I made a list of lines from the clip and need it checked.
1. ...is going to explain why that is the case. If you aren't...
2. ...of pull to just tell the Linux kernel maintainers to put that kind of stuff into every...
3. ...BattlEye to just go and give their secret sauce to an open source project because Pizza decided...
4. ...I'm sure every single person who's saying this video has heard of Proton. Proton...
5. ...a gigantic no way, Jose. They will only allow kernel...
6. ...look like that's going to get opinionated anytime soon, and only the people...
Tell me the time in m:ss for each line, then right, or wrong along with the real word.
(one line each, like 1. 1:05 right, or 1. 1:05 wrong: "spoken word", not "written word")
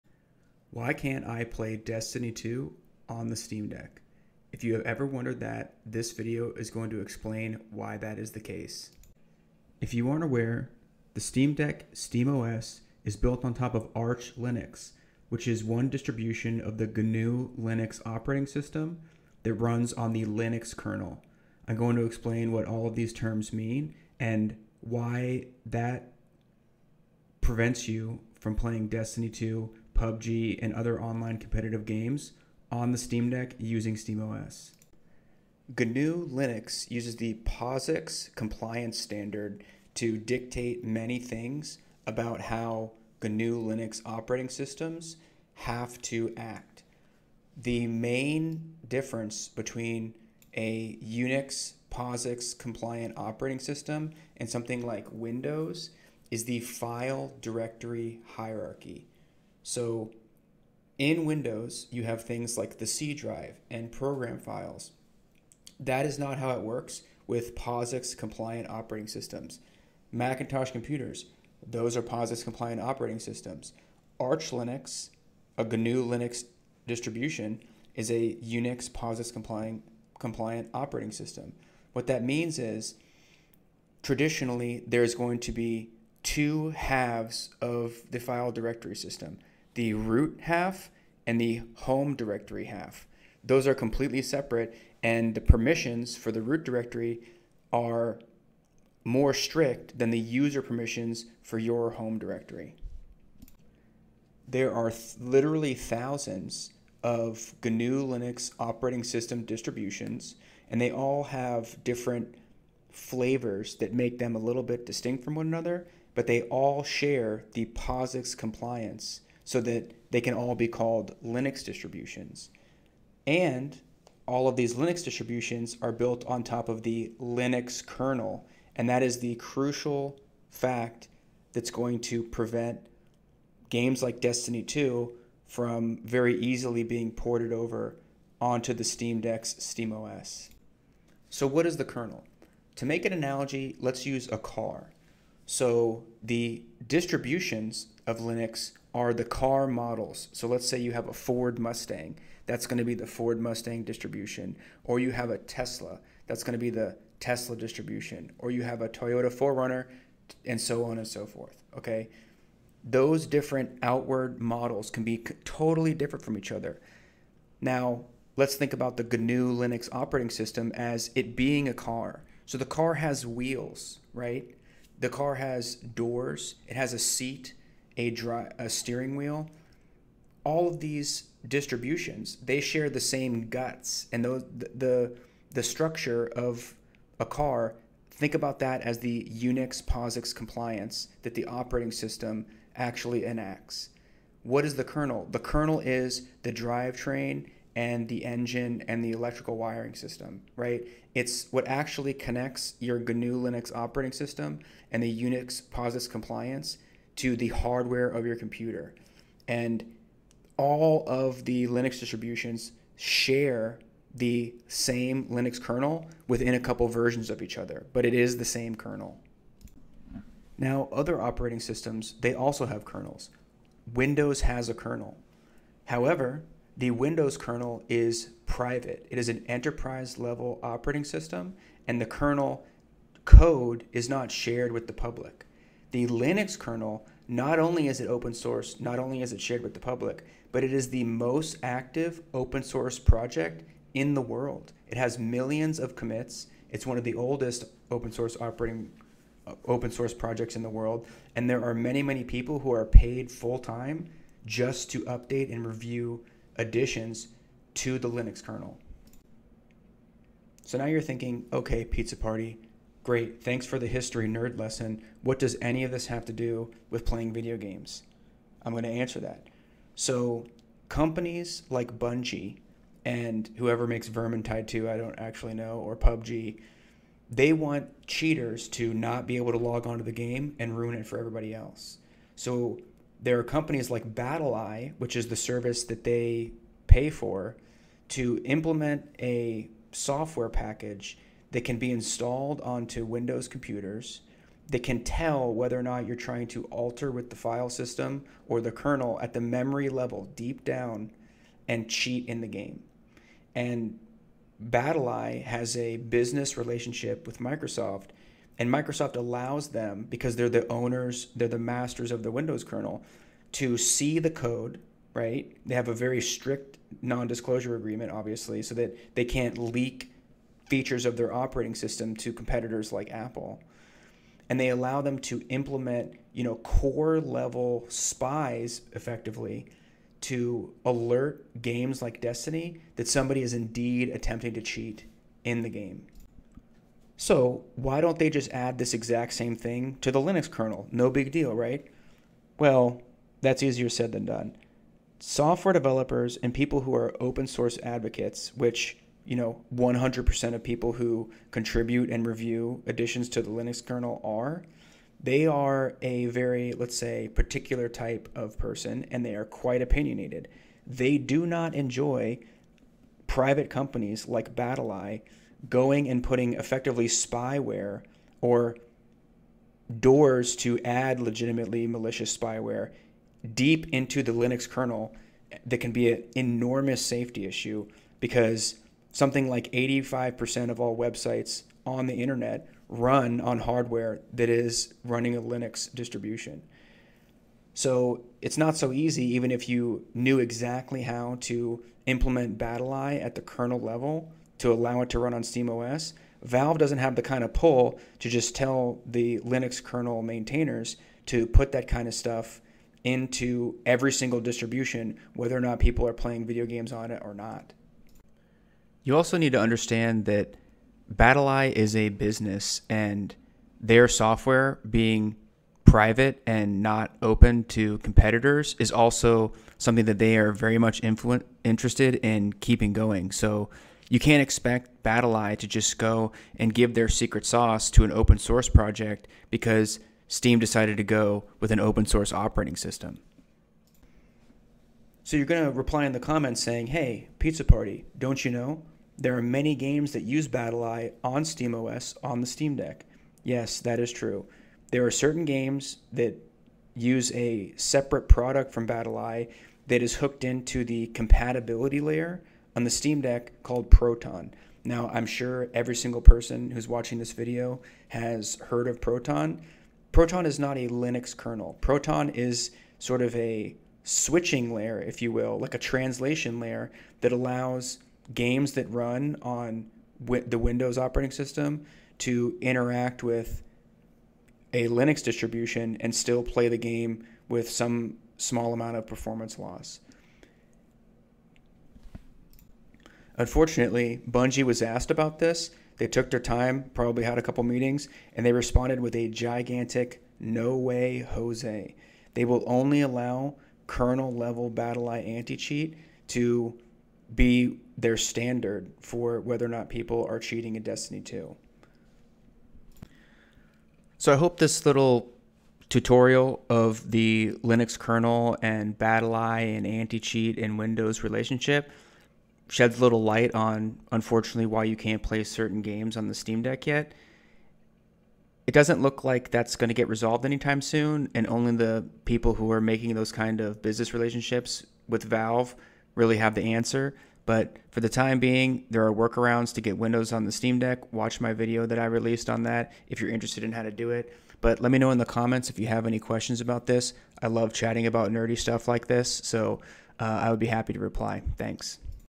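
1. 0:06 right
2. 6:37 right
3. 7:05 wrong: "Steam", not "Pizza"
4. 7:35 wrong: "watching", not "saying"
5. 8:09 right
6. 8:39 wrong: "resolved", not "opinionated".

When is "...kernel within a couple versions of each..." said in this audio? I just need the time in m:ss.
3:35.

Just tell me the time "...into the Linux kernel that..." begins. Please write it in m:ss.
6:13.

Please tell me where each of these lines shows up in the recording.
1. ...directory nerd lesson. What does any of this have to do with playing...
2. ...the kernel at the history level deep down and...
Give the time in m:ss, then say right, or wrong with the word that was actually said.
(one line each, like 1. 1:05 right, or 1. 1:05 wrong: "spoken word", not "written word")
1. 4:23 wrong: "history", not "directory"
2. 4:58 wrong: "memory", not "history".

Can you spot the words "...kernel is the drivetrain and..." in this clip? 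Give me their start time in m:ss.
3:15.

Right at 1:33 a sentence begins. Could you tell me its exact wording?
Those are completely separate, and the permissions for the root directory are more strict than the user permissions for your home directory.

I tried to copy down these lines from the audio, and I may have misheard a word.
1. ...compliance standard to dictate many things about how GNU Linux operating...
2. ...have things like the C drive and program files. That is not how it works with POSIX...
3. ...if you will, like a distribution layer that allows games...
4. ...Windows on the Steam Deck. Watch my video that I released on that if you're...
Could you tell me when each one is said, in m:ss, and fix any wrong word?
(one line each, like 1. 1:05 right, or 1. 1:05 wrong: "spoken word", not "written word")
1. 0:38 right
2. 1:02 right
3. 7:45 wrong: "translation", not "distribution"
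4. 8:49 right.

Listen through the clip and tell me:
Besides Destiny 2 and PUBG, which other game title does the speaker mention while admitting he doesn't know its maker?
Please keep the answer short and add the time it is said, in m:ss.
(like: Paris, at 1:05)
Vermintide 2, at 4:34.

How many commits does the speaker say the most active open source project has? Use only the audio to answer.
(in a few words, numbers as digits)
millions.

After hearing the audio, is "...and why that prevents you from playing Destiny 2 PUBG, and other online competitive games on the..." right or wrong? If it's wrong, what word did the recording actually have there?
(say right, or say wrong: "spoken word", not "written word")
right.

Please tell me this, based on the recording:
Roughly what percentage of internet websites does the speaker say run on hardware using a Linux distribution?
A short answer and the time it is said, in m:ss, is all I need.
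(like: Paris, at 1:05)
85%, at 6:19.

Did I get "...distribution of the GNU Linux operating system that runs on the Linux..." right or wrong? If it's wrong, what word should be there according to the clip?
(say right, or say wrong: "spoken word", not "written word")
right.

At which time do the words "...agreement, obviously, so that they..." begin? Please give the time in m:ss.
5:17.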